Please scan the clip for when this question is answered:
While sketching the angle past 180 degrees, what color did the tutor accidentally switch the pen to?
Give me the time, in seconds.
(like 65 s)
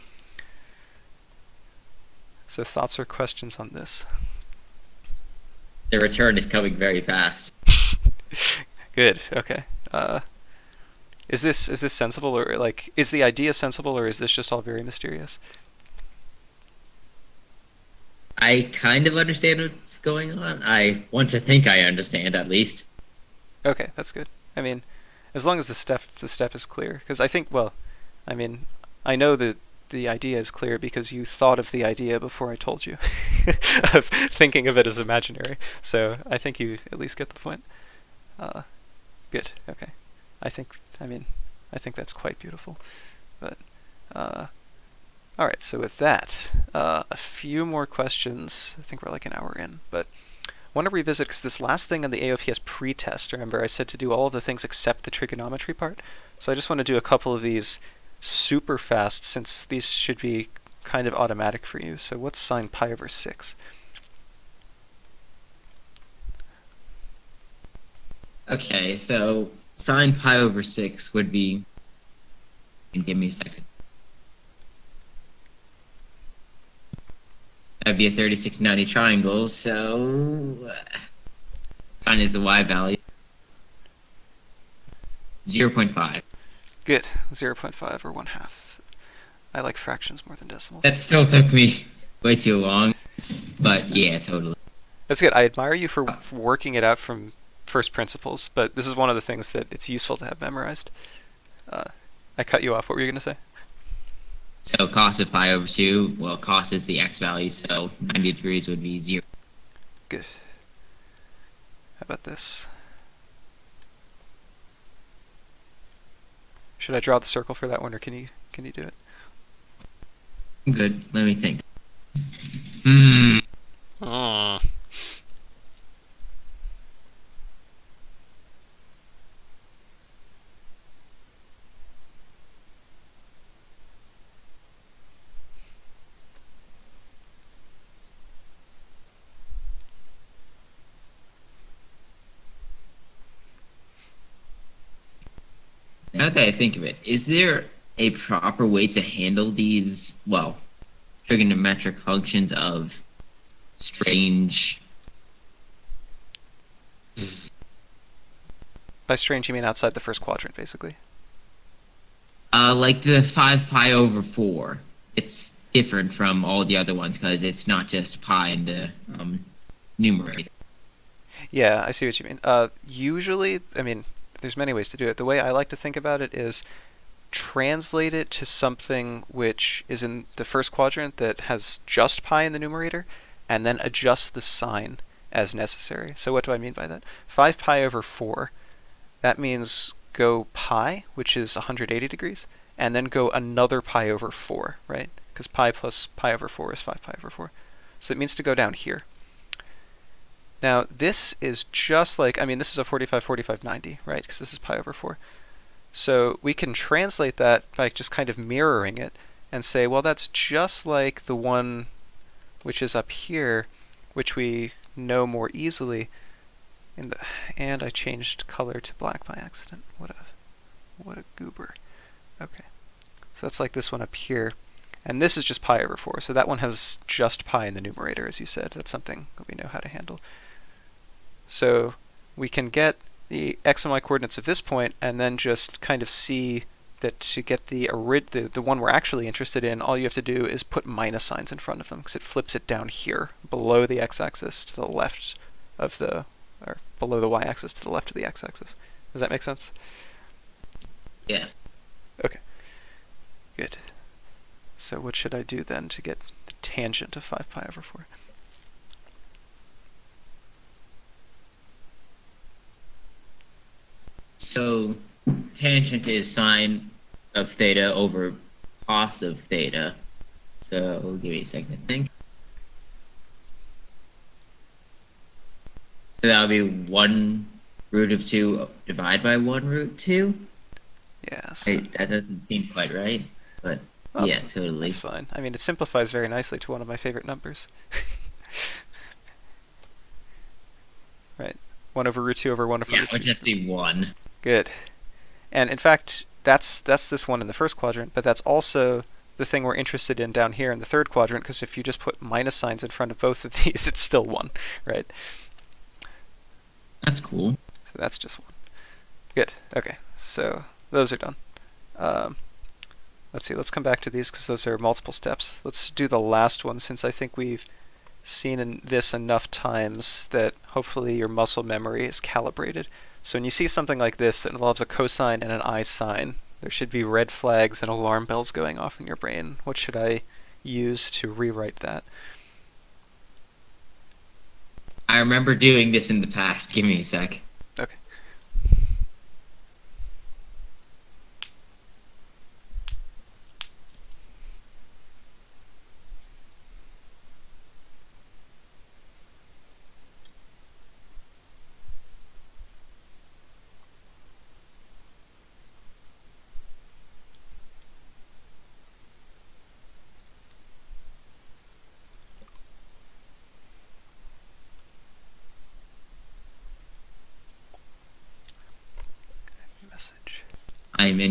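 218 s.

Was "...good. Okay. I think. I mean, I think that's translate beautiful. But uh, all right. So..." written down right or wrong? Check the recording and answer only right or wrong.
wrong.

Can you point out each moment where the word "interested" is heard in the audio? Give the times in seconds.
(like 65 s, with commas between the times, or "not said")
239 s, 299 s.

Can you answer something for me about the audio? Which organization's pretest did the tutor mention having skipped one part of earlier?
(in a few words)
AOPS.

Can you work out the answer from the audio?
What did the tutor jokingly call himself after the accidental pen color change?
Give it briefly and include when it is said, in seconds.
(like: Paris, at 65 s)
a goober, at 221 s.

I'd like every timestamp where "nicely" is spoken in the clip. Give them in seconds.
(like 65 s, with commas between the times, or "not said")
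286 s.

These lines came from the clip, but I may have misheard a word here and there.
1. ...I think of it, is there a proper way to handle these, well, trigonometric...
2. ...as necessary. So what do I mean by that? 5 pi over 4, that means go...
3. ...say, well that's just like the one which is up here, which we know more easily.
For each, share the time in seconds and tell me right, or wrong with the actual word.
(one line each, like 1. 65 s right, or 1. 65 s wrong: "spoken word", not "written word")
1. 146 s right
2. 185 s right
3. 209 s right.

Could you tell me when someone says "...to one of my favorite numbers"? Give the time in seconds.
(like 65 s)
286 s.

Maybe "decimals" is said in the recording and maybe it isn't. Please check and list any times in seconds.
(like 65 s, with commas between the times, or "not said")
90 s.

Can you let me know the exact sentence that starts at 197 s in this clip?
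So it means to go down here.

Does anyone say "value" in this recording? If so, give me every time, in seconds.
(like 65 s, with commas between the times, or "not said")
82 s, 107 s.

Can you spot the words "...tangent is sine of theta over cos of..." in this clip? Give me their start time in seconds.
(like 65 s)
265 s.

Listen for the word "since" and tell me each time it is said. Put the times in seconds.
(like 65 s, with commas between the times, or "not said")
59 s, 316 s.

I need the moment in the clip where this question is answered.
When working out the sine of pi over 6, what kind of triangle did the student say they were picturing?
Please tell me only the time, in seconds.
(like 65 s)
78 s.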